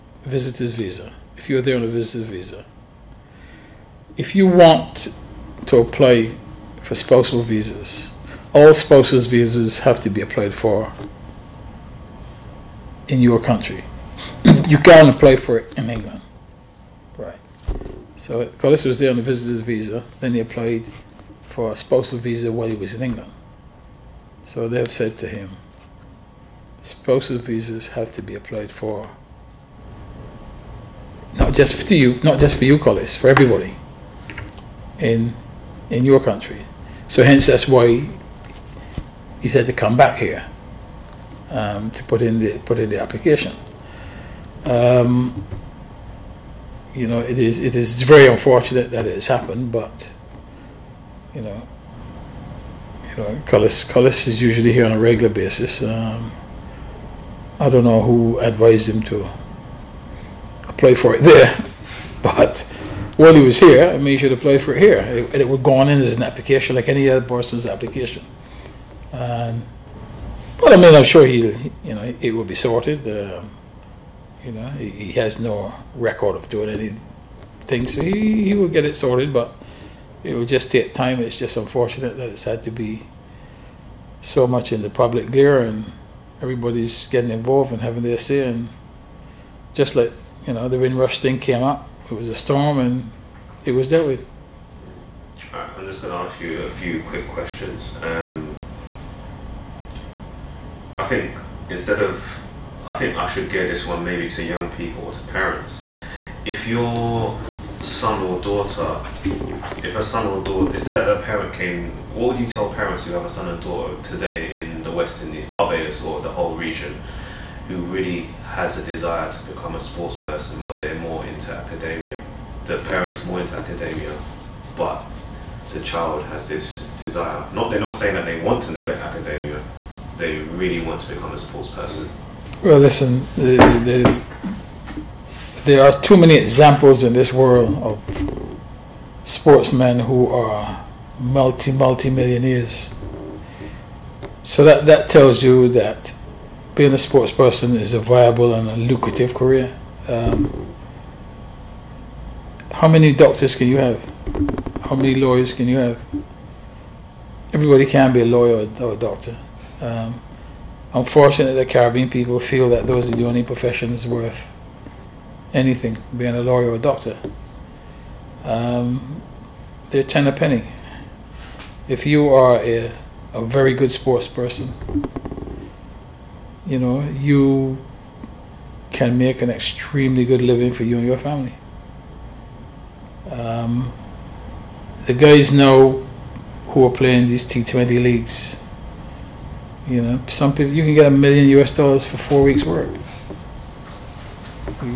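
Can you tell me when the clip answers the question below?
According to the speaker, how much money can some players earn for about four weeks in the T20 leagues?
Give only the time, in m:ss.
3:11.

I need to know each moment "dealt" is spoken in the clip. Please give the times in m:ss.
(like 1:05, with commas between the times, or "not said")
1:33.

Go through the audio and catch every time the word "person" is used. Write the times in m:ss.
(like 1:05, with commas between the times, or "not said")
1:07, 2:00, 2:11, 2:27, 2:54.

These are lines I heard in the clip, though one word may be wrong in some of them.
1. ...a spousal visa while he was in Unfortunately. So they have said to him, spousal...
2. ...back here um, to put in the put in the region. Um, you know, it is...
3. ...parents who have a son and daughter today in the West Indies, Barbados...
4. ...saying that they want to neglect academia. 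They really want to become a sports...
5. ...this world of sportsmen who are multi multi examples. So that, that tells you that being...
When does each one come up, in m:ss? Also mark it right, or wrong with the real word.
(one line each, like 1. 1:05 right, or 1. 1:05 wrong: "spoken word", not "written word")
1. 0:21 wrong: "England", not "Unfortunately"
2. 0:39 wrong: "application", not "region"
3. 1:52 right
4. 2:07 right
5. 2:17 wrong: "millionaires", not "examples".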